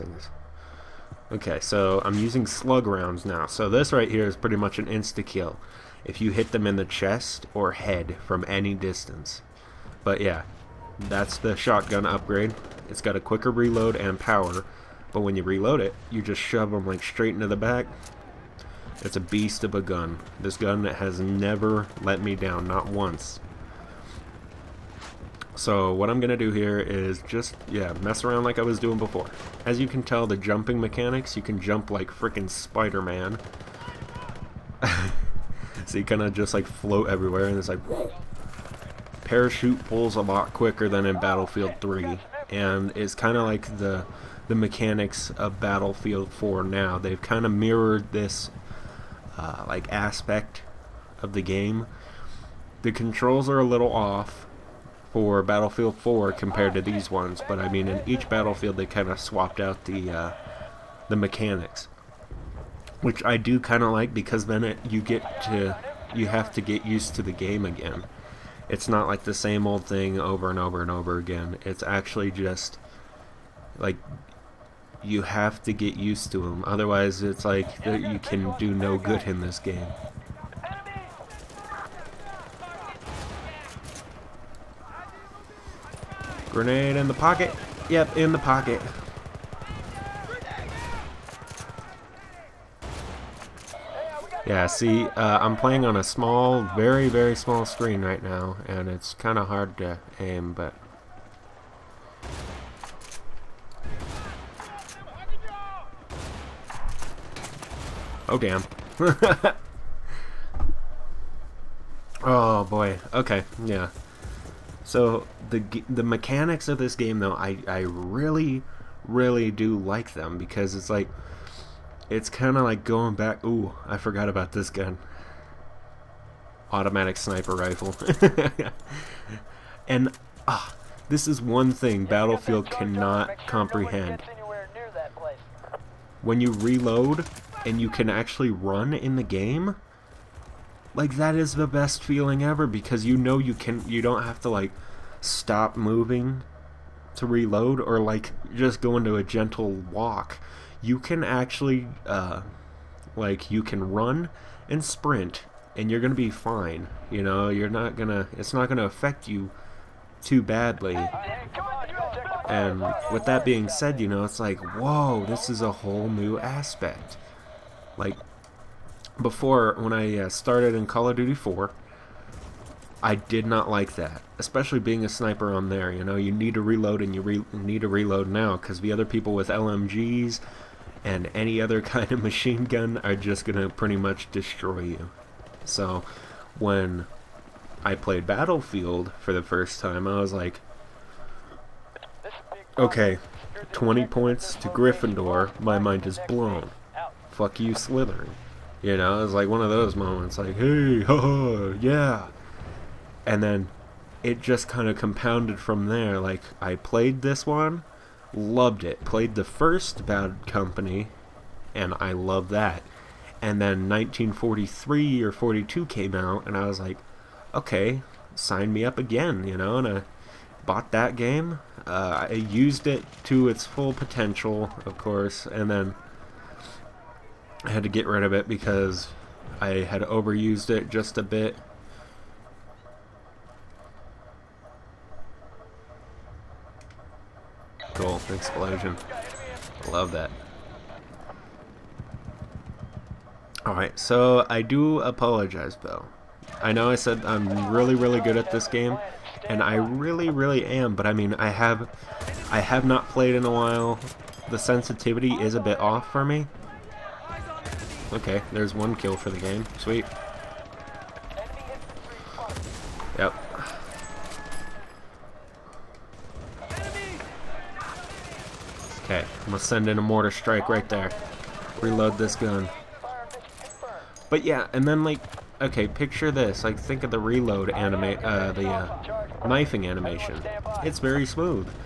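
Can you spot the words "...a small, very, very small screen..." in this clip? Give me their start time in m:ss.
1:35.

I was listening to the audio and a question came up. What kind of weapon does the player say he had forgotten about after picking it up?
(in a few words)
automatic sniper rifle.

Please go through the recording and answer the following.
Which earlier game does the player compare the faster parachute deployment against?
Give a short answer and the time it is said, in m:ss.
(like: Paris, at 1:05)
Battlefield 3, at 0:41.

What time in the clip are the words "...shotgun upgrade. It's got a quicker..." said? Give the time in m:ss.
0:11.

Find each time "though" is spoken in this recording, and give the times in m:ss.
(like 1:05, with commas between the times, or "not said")
1:57, 4:05.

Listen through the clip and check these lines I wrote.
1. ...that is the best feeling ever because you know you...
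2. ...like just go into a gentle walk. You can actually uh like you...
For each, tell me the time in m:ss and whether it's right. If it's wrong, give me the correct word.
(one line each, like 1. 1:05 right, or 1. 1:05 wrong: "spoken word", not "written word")
1. 2:21 right
2. 2:27 right.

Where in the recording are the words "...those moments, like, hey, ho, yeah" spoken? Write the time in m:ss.
3:19.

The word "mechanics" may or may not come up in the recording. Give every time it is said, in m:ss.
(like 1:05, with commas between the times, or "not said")
0:30, 0:44, 1:01, 1:56.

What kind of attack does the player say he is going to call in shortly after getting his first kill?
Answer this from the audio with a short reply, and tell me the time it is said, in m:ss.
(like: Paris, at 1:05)
mortar strike, at 4:30.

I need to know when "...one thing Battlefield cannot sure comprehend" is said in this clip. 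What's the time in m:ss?
2:11.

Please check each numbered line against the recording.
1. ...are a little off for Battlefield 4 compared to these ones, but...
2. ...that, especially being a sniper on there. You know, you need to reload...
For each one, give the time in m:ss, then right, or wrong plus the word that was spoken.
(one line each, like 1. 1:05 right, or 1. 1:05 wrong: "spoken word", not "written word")
1. 0:53 right
2. 2:53 right.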